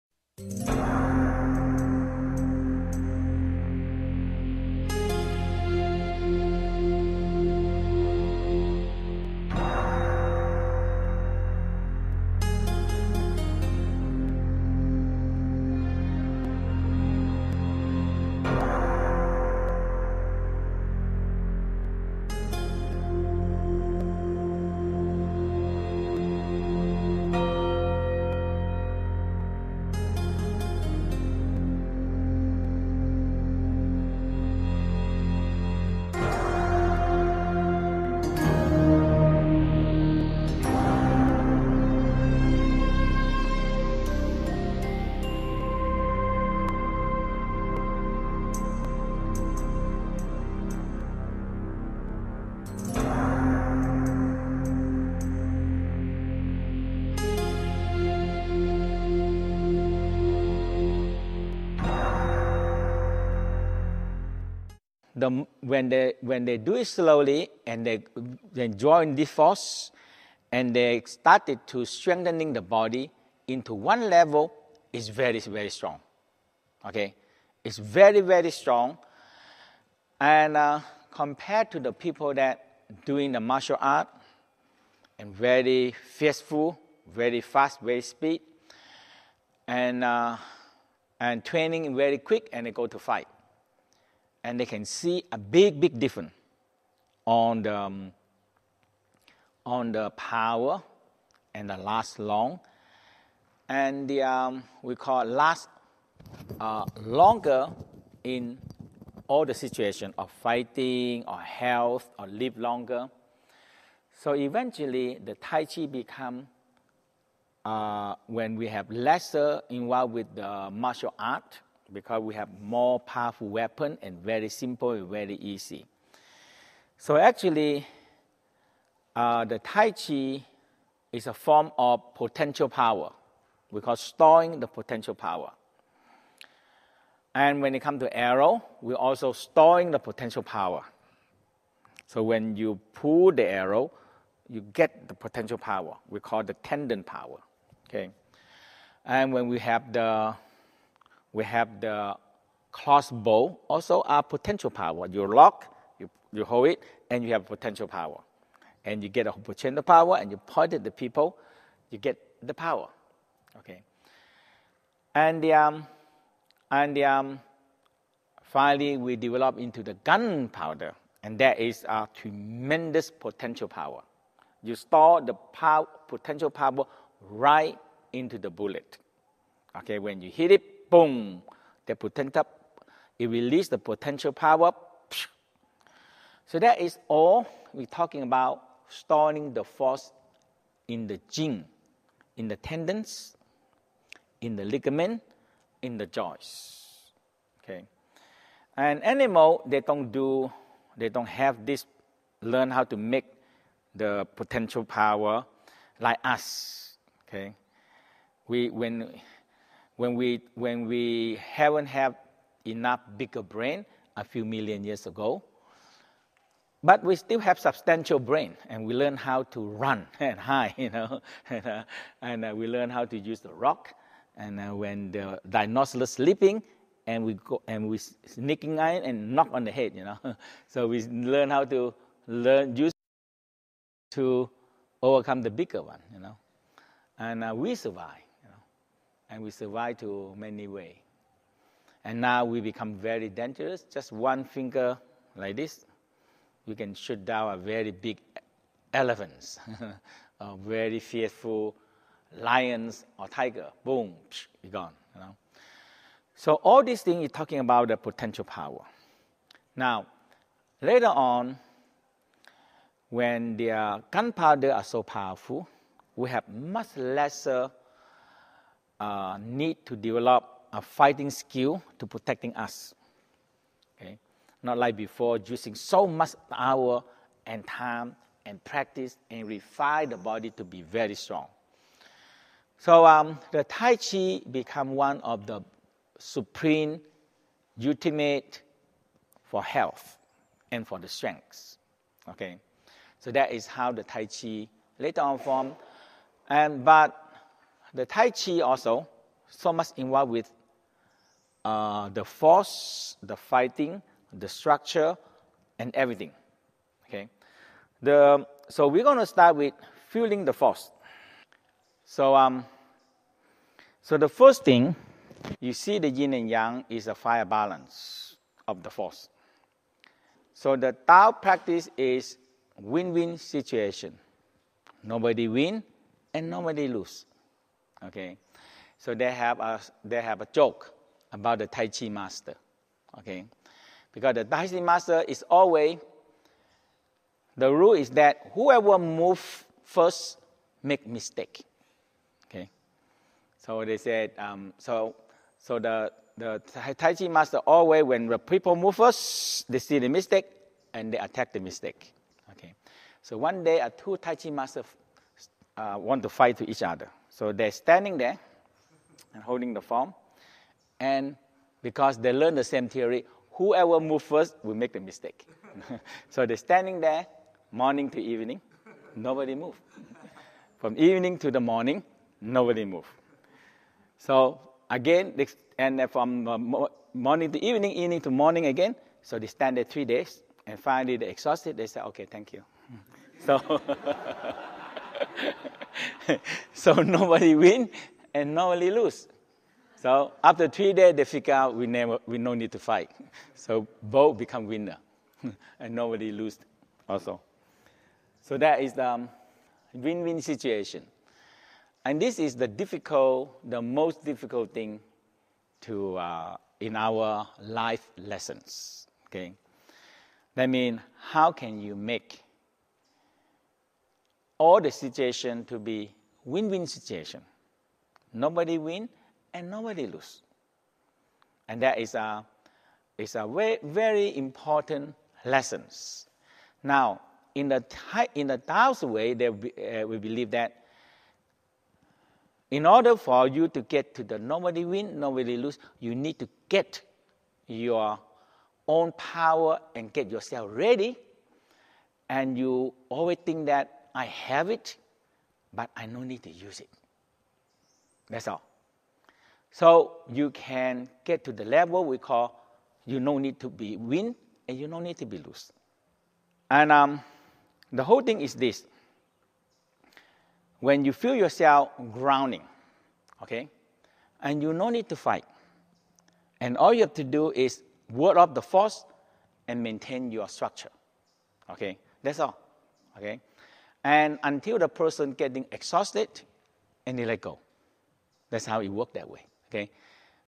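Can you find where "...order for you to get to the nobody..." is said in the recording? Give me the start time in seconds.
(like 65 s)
432 s.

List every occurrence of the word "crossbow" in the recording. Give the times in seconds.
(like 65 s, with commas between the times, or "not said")
152 s.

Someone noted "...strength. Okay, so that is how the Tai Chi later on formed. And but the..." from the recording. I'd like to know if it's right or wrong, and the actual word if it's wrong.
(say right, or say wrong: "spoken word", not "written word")
right.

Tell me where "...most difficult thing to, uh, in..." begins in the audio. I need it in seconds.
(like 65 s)
403 s.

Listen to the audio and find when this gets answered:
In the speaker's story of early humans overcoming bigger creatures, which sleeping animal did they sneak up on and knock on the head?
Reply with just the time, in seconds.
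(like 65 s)
225 s.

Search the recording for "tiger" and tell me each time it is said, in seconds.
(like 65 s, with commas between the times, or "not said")
253 s.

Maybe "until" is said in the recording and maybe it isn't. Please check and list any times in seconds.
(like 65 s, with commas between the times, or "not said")
474 s.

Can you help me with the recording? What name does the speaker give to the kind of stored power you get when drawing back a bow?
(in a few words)
tendon power.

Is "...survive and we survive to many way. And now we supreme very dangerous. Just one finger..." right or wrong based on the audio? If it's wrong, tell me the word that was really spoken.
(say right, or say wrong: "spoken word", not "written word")
wrong: "become", not "supreme".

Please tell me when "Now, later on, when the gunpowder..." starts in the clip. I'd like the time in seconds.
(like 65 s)
259 s.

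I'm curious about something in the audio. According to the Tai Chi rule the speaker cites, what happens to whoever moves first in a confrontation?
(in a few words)
make mistake.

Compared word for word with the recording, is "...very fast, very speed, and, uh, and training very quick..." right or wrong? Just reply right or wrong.
right.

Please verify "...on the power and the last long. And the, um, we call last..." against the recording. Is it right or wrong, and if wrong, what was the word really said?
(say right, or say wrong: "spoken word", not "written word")
right.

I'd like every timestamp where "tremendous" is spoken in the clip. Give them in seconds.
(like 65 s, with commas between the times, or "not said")
172 s.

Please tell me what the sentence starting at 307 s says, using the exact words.
Okay, the so we're gonna start with fueling the force.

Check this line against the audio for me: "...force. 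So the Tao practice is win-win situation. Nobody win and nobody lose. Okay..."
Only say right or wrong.
right.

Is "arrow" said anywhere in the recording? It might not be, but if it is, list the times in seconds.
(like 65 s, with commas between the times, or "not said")
138 s, 143 s.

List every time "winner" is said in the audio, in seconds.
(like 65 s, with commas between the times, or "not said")
394 s.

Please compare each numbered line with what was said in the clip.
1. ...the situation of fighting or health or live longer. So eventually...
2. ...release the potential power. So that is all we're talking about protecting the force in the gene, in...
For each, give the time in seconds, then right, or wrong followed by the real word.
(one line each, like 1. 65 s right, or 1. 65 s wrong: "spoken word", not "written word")
1. 109 s right
2. 183 s wrong: "storing", not "protecting".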